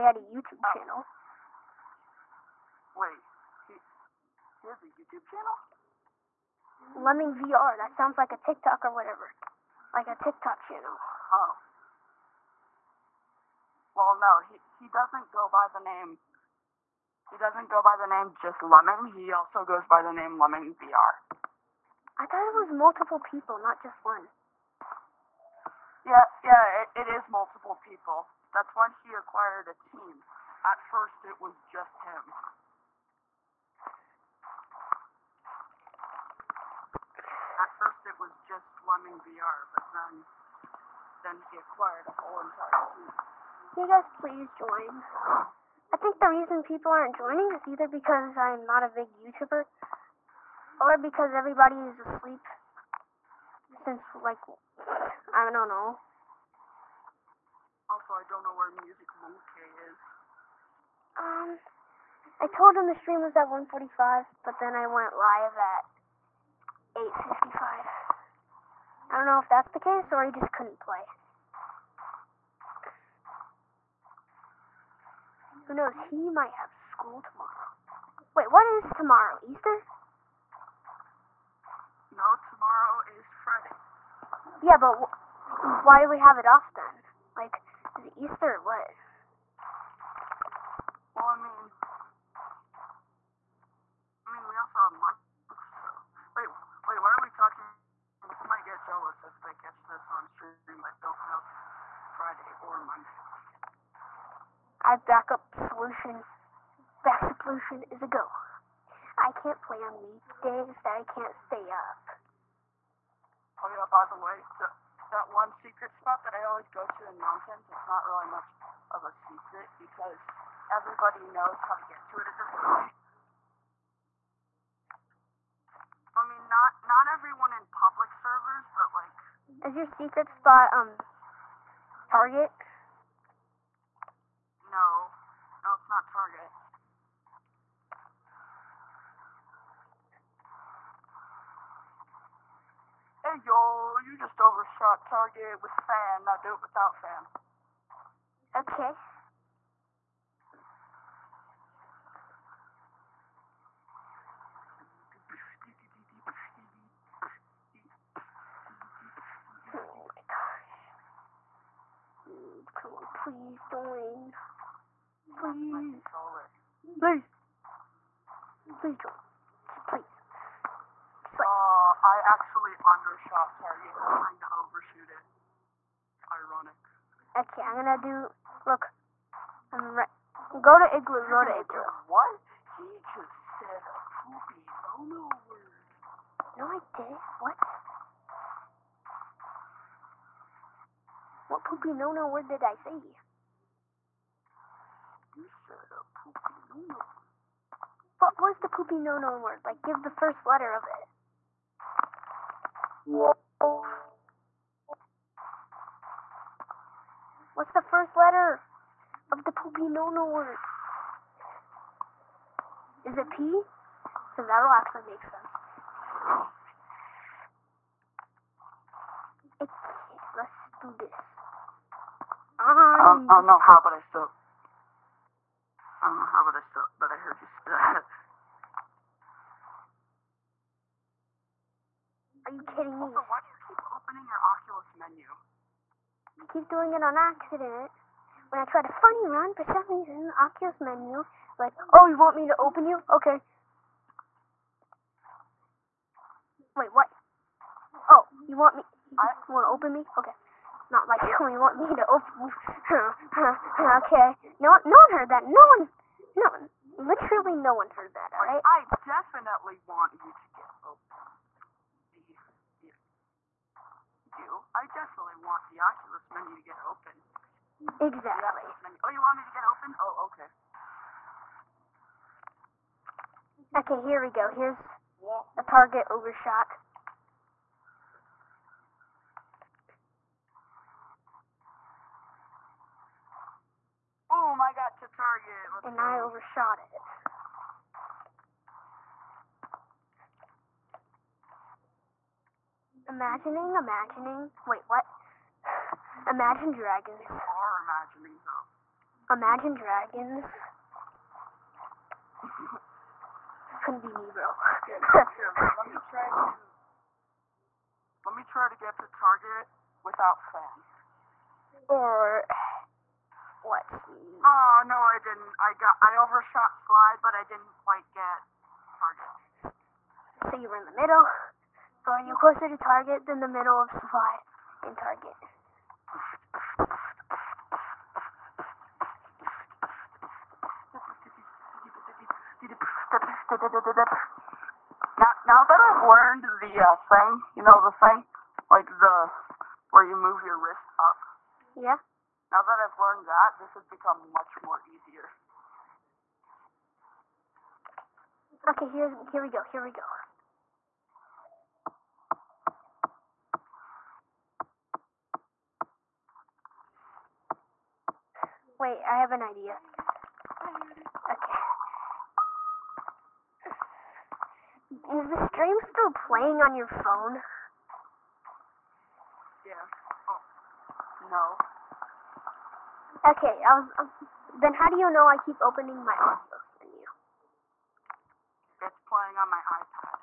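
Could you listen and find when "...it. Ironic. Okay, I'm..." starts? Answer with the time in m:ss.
2:55.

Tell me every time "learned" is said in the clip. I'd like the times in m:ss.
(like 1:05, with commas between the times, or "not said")
5:36, 5:43.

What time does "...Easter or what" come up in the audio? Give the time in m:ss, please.
1:28.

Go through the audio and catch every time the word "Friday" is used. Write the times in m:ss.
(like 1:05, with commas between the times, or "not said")
1:23, 1:42.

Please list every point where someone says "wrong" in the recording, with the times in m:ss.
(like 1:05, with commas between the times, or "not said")
not said.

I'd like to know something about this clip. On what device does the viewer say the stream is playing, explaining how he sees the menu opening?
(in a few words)
iPad.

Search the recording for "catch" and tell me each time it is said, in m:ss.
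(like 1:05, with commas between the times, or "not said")
1:39.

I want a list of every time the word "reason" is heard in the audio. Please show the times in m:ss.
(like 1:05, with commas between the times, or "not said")
0:46, 3:59.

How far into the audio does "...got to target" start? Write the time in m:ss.
4:44.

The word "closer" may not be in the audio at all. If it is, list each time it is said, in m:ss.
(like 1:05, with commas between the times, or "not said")
5:22.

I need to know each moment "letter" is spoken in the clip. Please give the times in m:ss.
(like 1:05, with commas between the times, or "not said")
3:20, 3:28.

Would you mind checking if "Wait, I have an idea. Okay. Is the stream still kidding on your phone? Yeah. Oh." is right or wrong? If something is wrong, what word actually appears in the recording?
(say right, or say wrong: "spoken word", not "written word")
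wrong: "playing", not "kidding".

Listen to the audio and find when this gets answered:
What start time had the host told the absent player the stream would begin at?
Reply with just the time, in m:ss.
1:03.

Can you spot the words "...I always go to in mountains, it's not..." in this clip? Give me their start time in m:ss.
1:56.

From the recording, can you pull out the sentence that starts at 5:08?
Let me try to get to target without fan.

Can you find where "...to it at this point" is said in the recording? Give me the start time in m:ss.
2:02.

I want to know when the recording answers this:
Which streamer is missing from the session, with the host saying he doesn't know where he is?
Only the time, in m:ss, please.
0:58.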